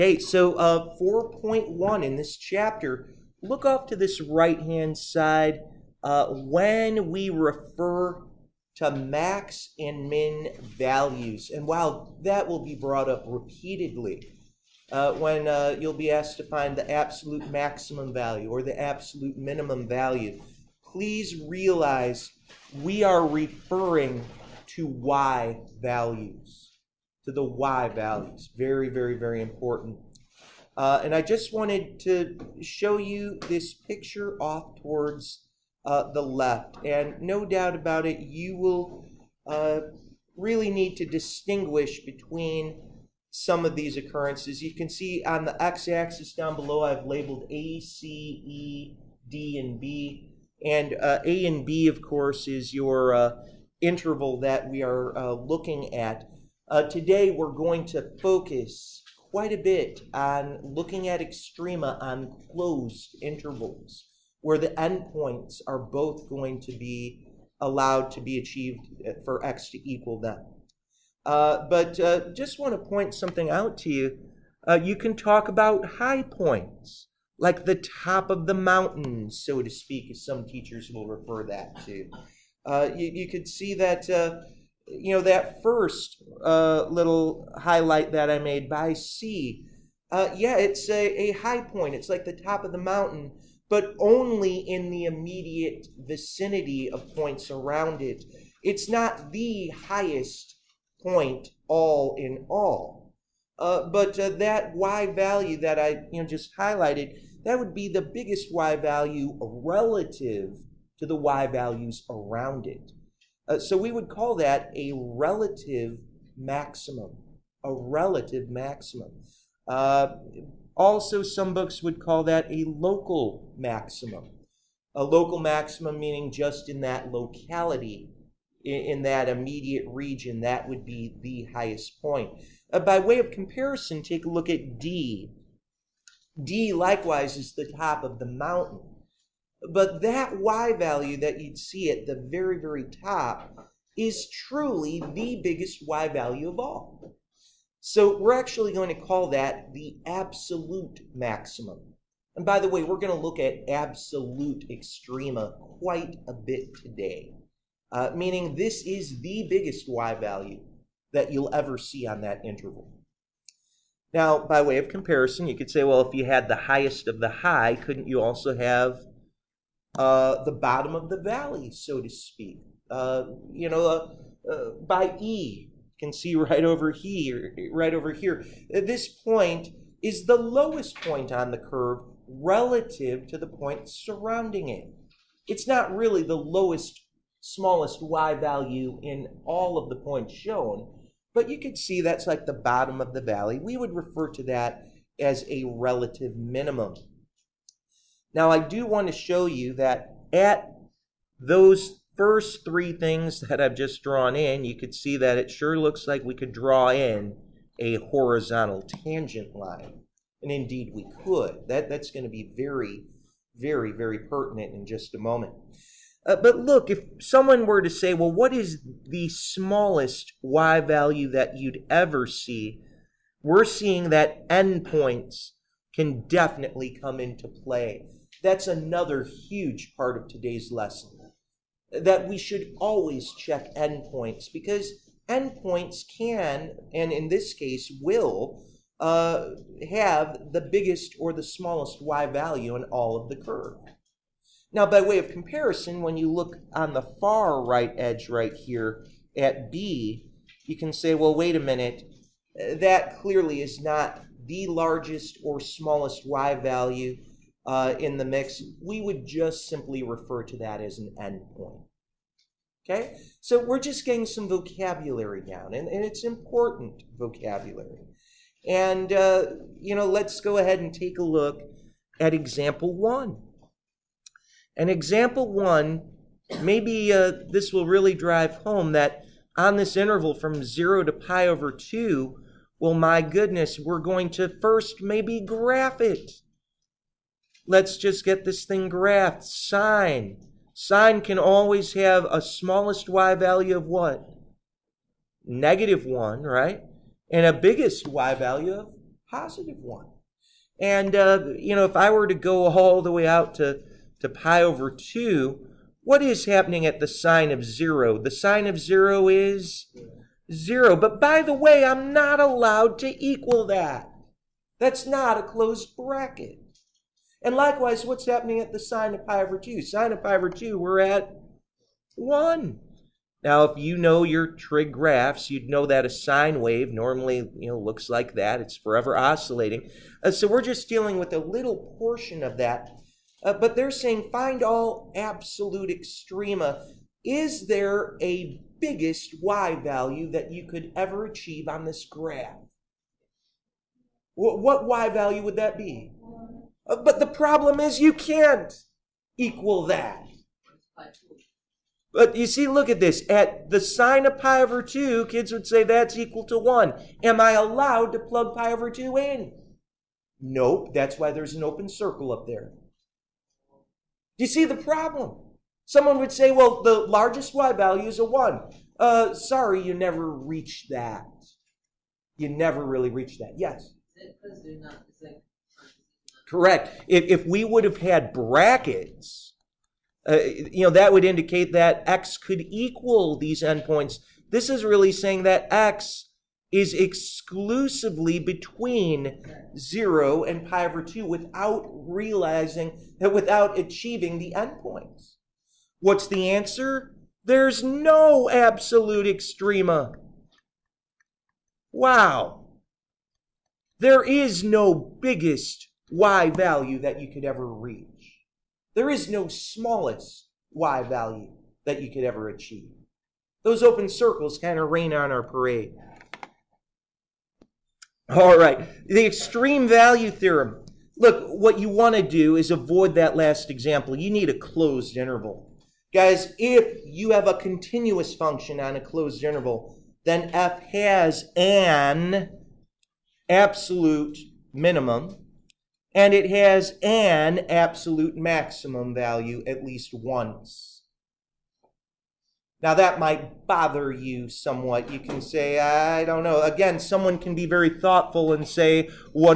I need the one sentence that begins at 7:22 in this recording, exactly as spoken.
Now, that might bother you somewhat.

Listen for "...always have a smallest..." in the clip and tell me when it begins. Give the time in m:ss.
4:51.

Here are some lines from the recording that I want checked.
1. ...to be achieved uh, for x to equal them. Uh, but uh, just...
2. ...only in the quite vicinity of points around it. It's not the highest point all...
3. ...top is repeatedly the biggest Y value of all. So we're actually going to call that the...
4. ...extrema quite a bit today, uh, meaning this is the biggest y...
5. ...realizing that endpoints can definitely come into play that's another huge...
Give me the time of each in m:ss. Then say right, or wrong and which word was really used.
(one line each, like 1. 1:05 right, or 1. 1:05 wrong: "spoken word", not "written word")
1. 1:08 right
2. 1:33 wrong: "immediate", not "quite"
3. 2:22 wrong: "truly", not "repeatedly"
4. 2:34 right
5. 3:43 wrong: "seeing", not "realizing".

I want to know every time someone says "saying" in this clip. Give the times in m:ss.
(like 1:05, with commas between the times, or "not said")
5:33, 6:25.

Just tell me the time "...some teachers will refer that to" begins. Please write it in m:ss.
1:20.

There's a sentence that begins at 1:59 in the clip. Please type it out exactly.
Uh, also, some books would call that a local maximum.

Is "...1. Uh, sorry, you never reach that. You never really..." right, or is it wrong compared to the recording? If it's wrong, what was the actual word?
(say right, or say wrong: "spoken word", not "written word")
right.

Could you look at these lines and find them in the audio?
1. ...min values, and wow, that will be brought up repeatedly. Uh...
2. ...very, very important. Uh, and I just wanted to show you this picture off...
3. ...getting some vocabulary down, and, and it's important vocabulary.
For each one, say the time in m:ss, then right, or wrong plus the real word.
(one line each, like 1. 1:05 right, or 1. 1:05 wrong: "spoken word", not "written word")
1. 0:10 right
2. 0:28 right
3. 4:24 right.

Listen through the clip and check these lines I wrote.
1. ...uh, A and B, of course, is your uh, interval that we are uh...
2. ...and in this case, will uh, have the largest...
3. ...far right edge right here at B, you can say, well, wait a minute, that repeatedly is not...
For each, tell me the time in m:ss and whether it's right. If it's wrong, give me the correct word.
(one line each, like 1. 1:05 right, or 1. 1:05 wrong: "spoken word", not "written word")
1. 0:51 right
2. 3:56 wrong: "biggest", not "largest"
3. 4:07 wrong: "clearly", not "repeatedly".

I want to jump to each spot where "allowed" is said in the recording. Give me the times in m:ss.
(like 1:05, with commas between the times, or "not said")
1:07, 5:12, 5:57.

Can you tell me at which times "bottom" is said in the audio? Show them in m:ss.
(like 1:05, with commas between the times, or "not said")
2:50, 3:12.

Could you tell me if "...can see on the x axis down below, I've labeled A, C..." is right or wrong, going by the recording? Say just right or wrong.
right.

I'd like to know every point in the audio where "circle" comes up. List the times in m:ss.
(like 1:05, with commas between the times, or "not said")
6:01, 6:54.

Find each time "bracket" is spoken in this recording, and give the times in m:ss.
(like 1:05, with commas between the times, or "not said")
5:15, 6:18.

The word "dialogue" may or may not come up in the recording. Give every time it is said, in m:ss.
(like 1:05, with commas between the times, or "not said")
not said.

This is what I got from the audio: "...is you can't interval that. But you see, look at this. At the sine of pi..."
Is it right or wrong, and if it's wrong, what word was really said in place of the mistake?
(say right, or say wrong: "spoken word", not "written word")
wrong: "equal", not "interval".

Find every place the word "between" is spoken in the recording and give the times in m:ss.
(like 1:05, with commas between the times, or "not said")
0:42, 6:28.